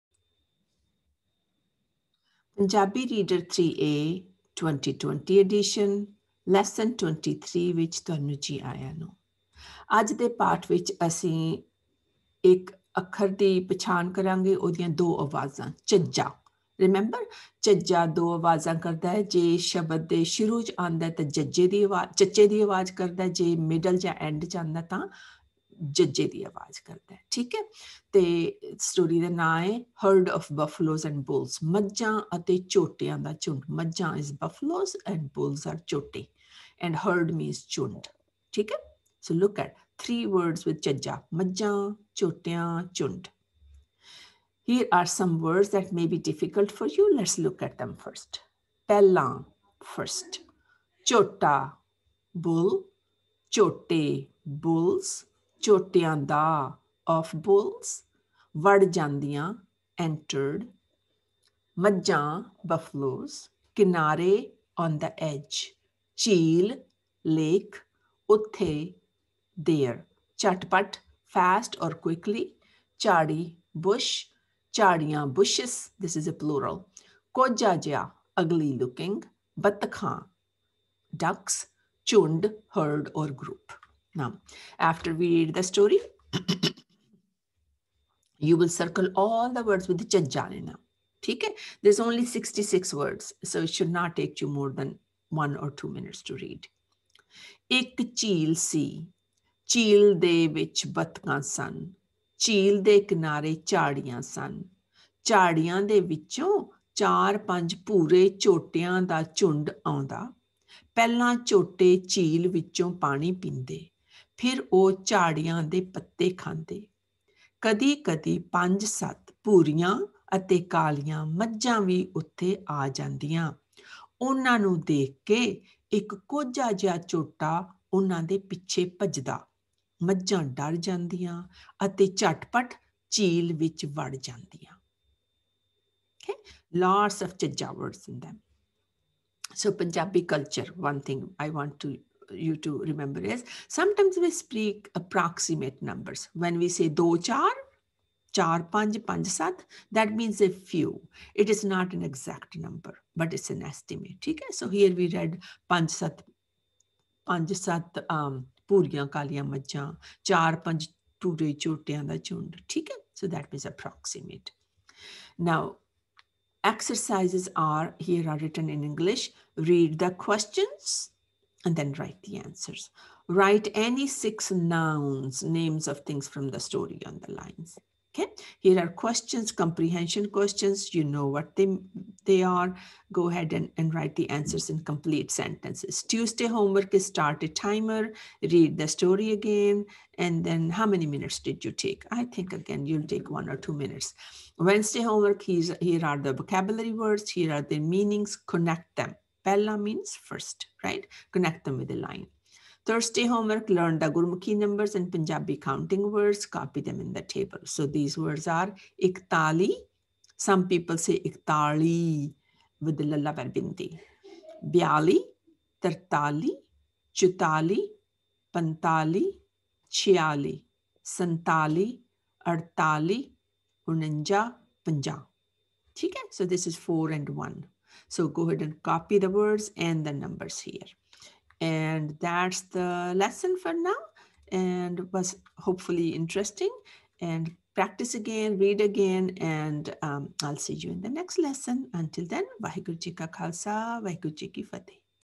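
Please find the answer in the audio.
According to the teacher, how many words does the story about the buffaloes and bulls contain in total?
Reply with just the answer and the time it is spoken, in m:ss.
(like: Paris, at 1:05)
66, at 1:32.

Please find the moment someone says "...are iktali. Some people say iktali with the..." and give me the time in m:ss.
3:28.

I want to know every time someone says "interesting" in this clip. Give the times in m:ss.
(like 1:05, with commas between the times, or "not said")
3:56.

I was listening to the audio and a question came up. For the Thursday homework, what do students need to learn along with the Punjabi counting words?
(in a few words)
Gurmukhi numbers.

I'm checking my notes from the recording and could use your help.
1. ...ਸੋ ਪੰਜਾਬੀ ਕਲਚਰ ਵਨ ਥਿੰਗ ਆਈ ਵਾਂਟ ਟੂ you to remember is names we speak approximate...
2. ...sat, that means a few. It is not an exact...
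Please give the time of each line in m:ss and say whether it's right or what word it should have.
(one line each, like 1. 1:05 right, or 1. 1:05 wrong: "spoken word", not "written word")
1. 2:19 wrong: "sometimes", not "names"
2. 2:29 right.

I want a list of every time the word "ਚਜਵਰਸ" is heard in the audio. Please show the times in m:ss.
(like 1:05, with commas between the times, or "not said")
2:17.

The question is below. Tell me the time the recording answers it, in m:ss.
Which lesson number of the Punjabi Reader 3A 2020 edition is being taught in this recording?
0:06.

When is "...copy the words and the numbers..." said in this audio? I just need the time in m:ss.
3:48.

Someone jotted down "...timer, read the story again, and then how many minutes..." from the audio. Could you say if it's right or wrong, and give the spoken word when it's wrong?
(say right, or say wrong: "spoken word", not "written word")
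right.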